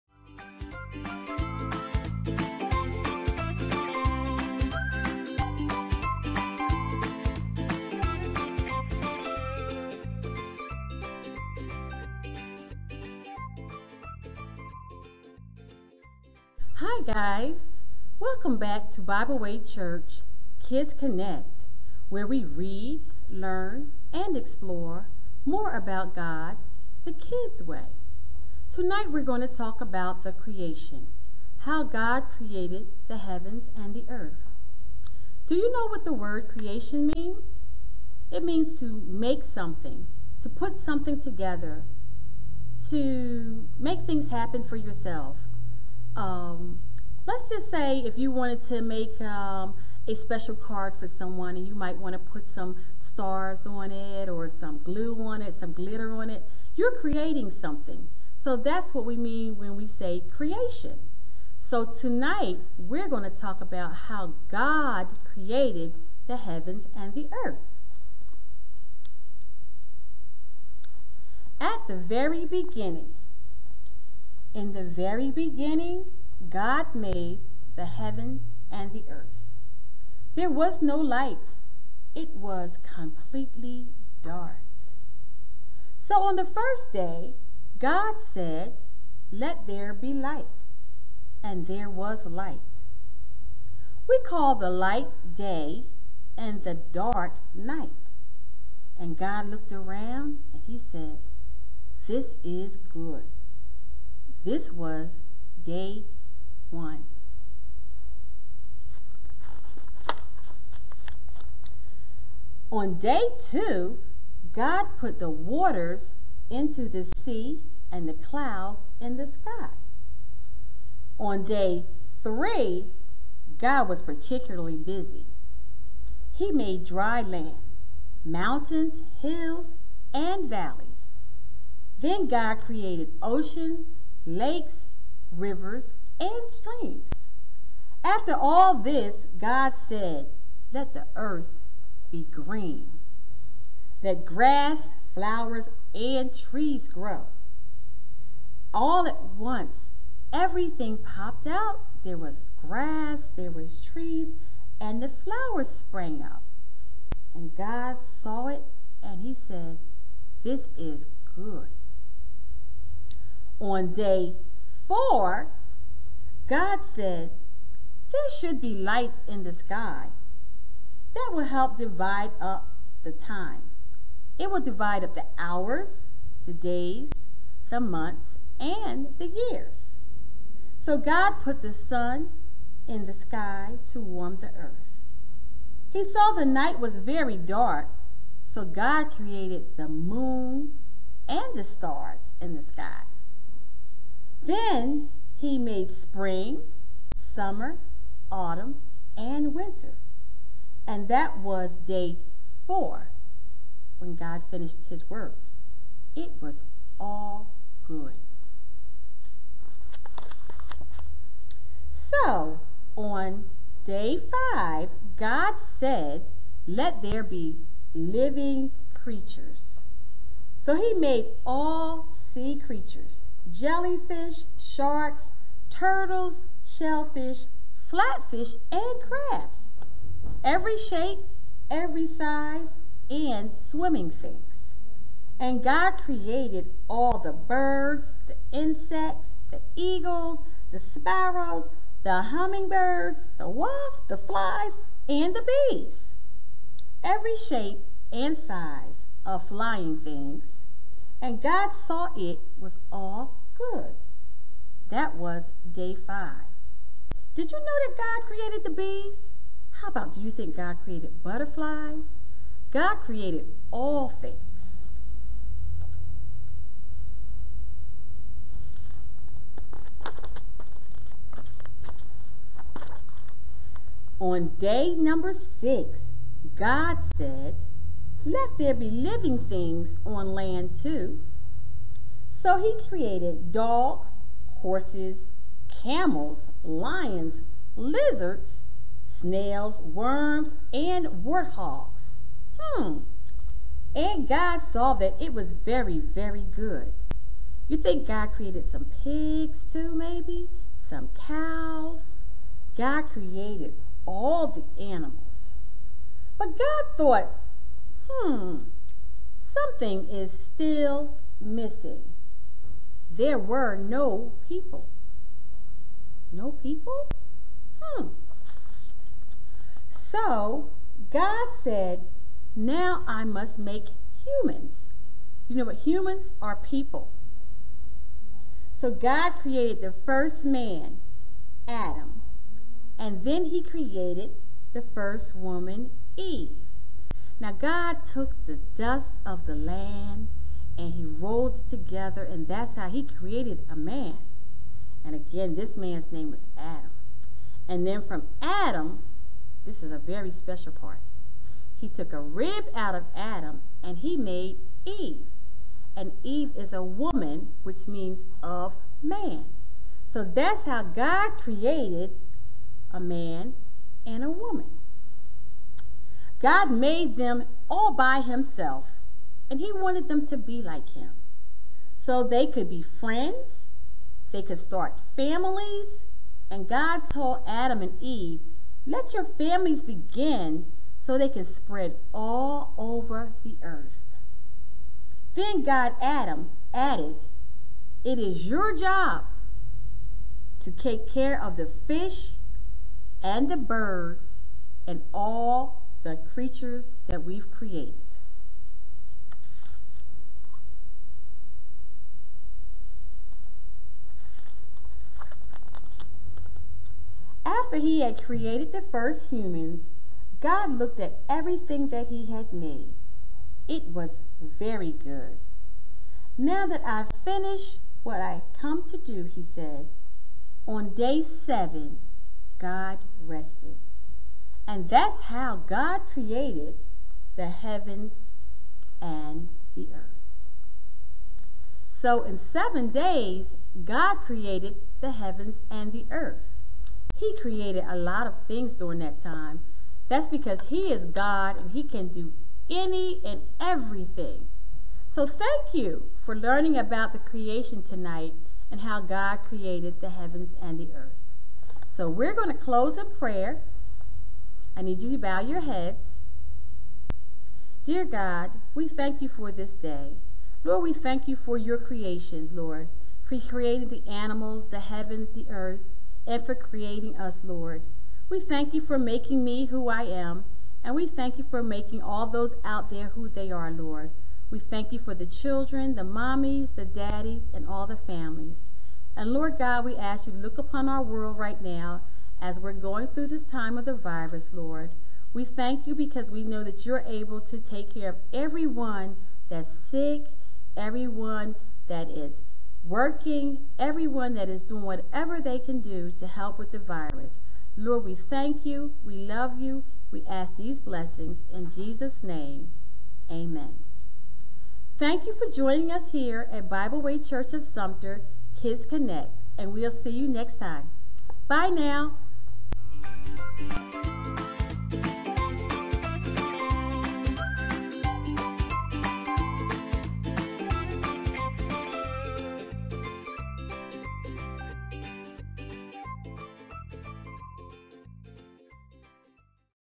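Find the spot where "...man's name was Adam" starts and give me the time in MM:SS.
05:45.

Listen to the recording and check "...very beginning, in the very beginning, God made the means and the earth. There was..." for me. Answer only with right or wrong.
wrong.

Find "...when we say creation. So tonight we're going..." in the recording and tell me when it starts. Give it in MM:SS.
00:59.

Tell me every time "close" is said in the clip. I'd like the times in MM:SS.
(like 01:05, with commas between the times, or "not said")
07:32.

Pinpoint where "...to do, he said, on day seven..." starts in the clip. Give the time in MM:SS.
06:58.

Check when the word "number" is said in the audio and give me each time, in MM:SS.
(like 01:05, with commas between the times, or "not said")
04:34.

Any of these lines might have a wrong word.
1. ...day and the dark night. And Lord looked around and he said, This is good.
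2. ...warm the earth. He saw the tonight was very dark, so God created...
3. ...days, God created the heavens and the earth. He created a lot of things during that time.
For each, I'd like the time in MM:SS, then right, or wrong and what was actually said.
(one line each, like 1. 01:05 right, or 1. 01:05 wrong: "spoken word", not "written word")
1. 01:35 wrong: "God", not "Lord"
2. 03:04 wrong: "night", not "tonight"
3. 07:12 right.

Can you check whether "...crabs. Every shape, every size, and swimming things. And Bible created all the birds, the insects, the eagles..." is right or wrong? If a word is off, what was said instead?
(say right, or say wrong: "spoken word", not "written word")
wrong: "God", not "Bible".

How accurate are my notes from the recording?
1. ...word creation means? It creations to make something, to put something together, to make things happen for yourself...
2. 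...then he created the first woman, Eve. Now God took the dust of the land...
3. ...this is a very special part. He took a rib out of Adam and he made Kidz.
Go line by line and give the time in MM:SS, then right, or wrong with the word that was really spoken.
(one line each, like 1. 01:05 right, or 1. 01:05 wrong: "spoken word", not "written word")
1. 00:36 wrong: "means", not "creations"
2. 05:33 right
3. 05:49 wrong: "Eve", not "Kidz".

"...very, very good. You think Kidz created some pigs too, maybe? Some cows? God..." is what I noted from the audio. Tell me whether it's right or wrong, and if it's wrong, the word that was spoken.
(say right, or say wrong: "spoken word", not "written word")
wrong: "God", not "Kidz".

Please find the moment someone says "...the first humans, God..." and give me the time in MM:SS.
06:48.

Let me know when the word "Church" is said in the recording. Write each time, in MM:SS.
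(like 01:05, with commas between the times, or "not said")
00:19, 08:27.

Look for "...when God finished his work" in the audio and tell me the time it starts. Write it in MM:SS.
03:23.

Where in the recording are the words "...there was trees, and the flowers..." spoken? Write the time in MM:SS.
02:33.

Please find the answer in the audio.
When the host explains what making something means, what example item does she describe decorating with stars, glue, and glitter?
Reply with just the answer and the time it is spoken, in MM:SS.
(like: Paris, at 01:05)
a special card, at 00:50.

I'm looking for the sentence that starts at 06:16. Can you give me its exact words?
And God told Adam and Eve, let your families begin so they can spread all over the earth.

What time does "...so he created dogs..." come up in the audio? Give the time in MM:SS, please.
04:42.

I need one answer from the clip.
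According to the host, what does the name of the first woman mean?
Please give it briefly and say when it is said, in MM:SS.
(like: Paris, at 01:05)
of man, at 05:58.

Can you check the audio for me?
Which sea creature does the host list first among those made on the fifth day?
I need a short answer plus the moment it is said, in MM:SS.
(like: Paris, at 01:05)
jellyfish, at 03:43.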